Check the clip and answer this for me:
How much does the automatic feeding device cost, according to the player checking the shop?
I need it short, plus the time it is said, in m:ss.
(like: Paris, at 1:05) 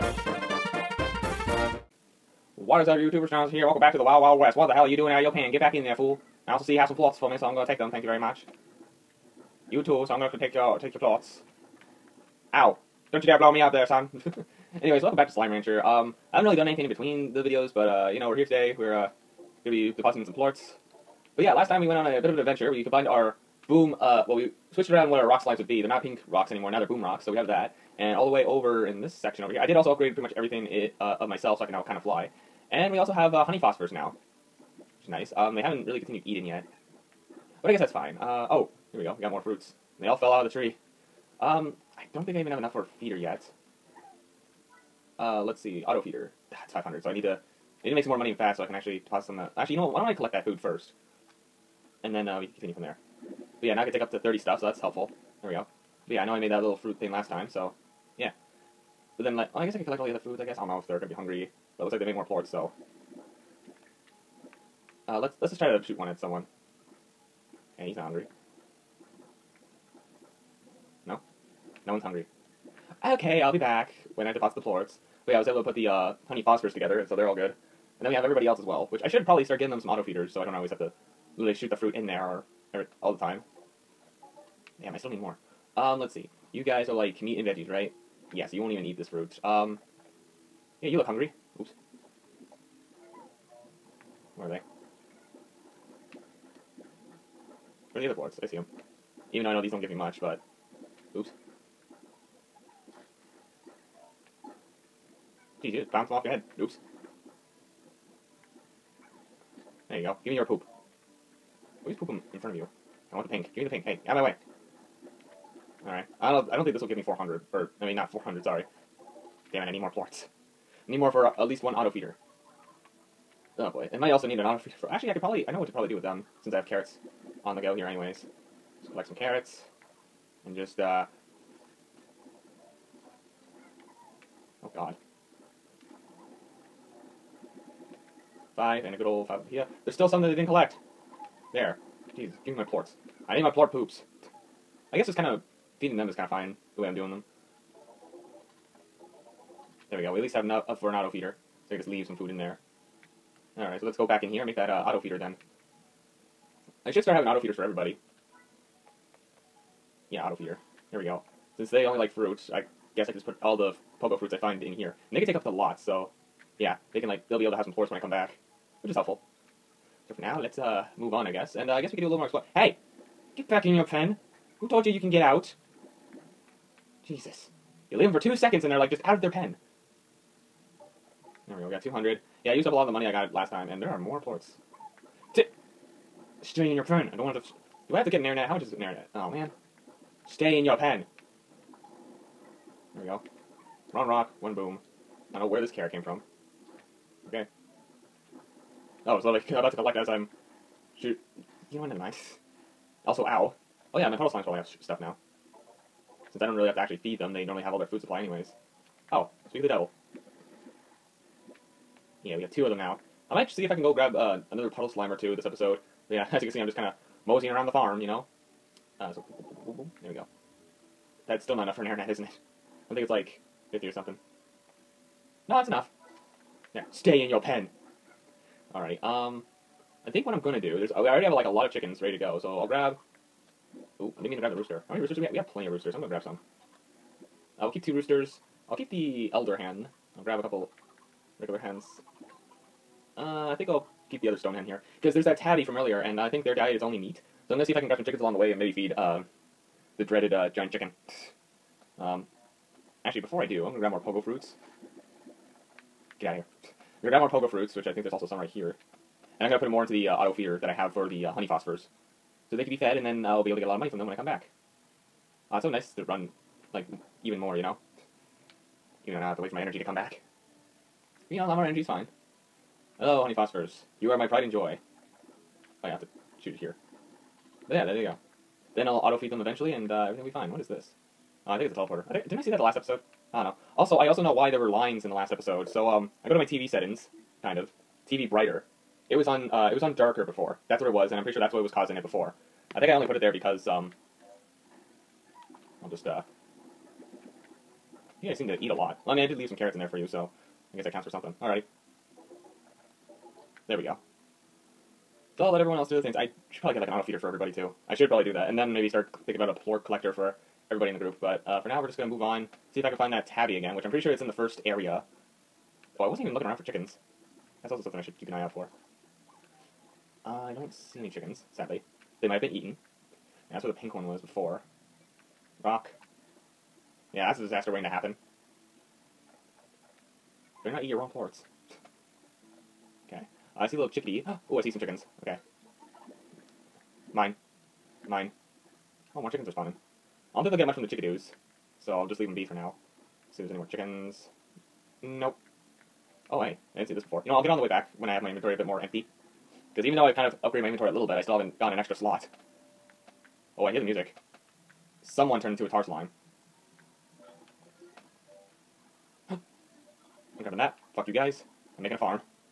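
500, at 0:46.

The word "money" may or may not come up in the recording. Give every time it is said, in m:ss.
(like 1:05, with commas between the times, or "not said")
0:48, 3:02, 4:23.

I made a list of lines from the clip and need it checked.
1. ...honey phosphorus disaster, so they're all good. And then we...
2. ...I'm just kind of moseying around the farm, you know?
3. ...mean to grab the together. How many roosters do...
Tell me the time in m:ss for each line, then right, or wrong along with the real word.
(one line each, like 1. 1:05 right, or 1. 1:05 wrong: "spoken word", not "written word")
1. 1:16 wrong: "together", not "disaster"
2. 3:36 right
3. 3:54 wrong: "rooster", not "together".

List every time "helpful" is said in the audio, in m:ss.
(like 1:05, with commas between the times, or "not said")
0:54, 2:48.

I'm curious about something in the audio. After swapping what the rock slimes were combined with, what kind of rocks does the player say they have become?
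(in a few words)
Boom rocks.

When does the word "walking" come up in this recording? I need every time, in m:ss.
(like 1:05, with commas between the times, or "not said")
not said.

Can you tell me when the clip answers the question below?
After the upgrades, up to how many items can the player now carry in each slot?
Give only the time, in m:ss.
0:53.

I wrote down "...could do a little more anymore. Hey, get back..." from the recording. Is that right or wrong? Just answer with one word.
wrong.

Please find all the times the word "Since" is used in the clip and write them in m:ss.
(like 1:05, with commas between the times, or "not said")
2:06, 2:41, 3:26.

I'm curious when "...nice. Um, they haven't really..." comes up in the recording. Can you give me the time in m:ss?
0:35.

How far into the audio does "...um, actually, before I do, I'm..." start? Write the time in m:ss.
4:11.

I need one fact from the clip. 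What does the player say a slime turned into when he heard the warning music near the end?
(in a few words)
Tar slime.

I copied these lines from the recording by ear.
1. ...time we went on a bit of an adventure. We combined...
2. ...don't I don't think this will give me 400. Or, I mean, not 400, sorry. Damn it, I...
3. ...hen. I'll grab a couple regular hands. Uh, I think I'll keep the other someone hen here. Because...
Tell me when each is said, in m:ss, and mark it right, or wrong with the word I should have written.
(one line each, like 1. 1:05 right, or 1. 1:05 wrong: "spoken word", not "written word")
1. 0:21 right
2. 1:56 right
3. 3:59 wrong: "stone", not "someone".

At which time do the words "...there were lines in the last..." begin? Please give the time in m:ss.
4:44.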